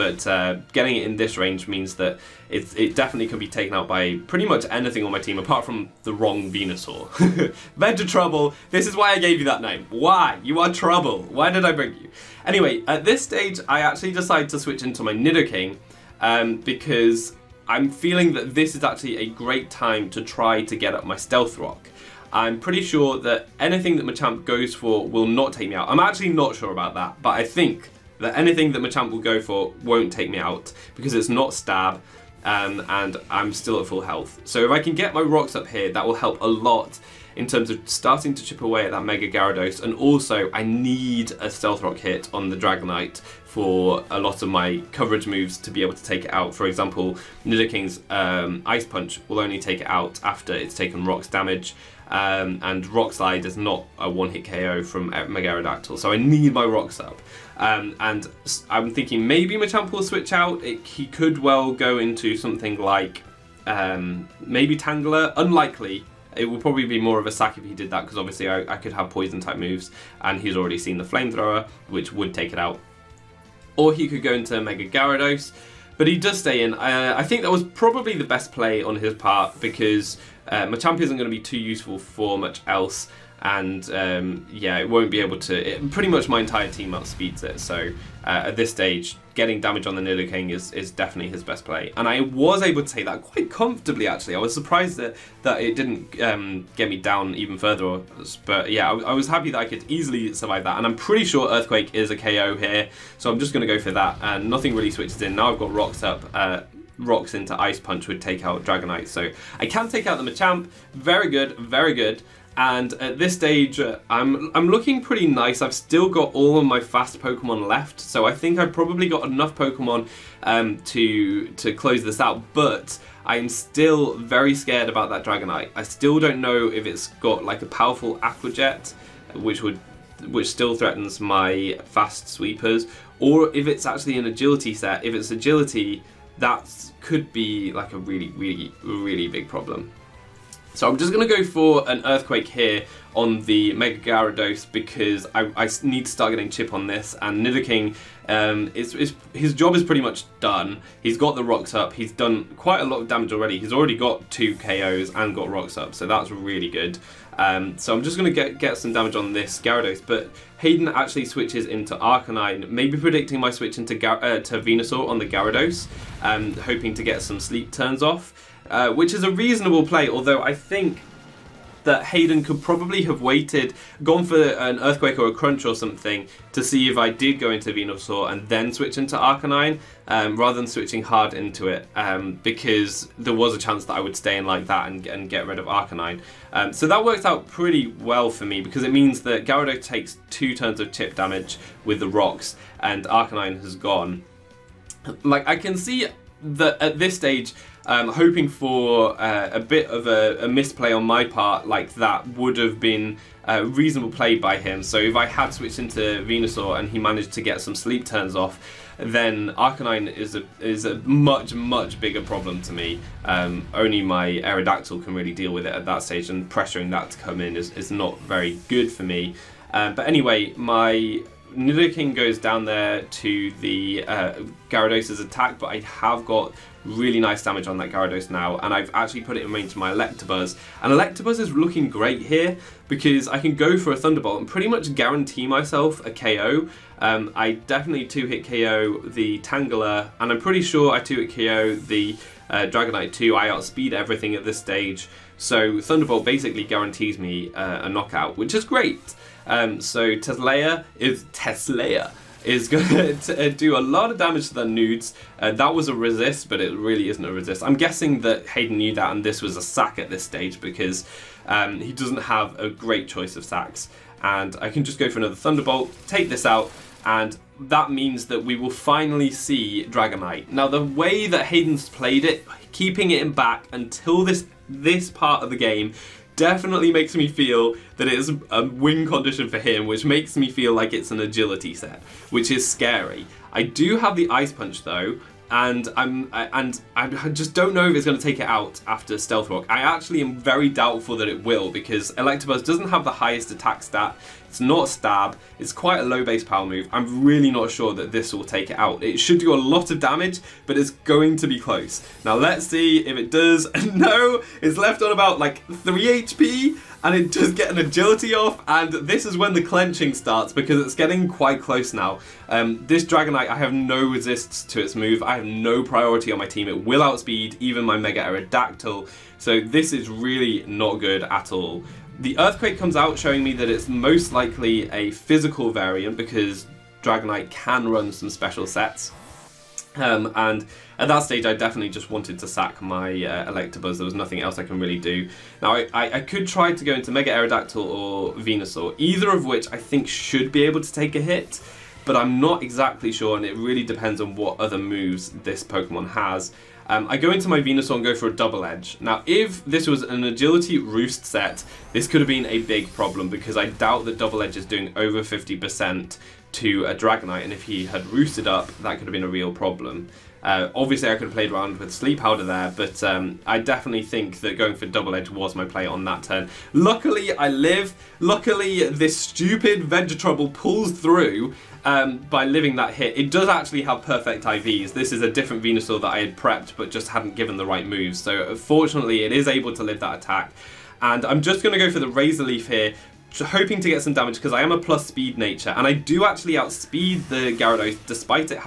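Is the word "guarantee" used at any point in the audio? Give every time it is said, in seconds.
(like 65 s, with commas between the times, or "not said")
234 s, 246 s.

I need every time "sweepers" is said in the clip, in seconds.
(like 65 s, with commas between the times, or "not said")
132 s.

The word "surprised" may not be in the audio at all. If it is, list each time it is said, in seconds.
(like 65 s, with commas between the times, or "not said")
94 s.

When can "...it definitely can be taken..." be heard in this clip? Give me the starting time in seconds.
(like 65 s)
2 s.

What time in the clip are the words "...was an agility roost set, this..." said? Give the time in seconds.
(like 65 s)
349 s.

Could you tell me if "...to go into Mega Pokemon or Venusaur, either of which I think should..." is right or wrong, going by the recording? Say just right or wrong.
wrong.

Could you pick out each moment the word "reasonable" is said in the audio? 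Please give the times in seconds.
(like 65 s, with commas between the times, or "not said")
169 s, 203 s.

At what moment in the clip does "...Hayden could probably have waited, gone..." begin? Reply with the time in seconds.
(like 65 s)
172 s.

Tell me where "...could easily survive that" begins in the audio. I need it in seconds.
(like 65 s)
99 s.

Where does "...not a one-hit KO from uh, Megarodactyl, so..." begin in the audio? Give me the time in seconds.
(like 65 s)
53 s.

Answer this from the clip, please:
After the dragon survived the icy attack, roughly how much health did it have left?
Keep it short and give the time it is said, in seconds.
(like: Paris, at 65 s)
3 HP, at 305 s.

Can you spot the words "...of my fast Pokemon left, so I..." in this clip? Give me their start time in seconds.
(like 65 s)
116 s.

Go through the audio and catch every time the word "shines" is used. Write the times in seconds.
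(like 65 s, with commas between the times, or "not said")
not said.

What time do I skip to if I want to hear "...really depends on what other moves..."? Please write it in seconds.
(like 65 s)
343 s.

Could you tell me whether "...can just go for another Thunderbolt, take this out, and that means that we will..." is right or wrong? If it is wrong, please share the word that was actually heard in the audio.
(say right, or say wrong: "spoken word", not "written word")
right.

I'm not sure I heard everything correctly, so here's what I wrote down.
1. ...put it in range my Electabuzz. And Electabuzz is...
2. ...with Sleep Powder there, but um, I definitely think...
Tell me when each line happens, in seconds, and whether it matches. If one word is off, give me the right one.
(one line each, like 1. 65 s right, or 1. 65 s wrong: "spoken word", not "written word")
1. 229 s right
2. 361 s right.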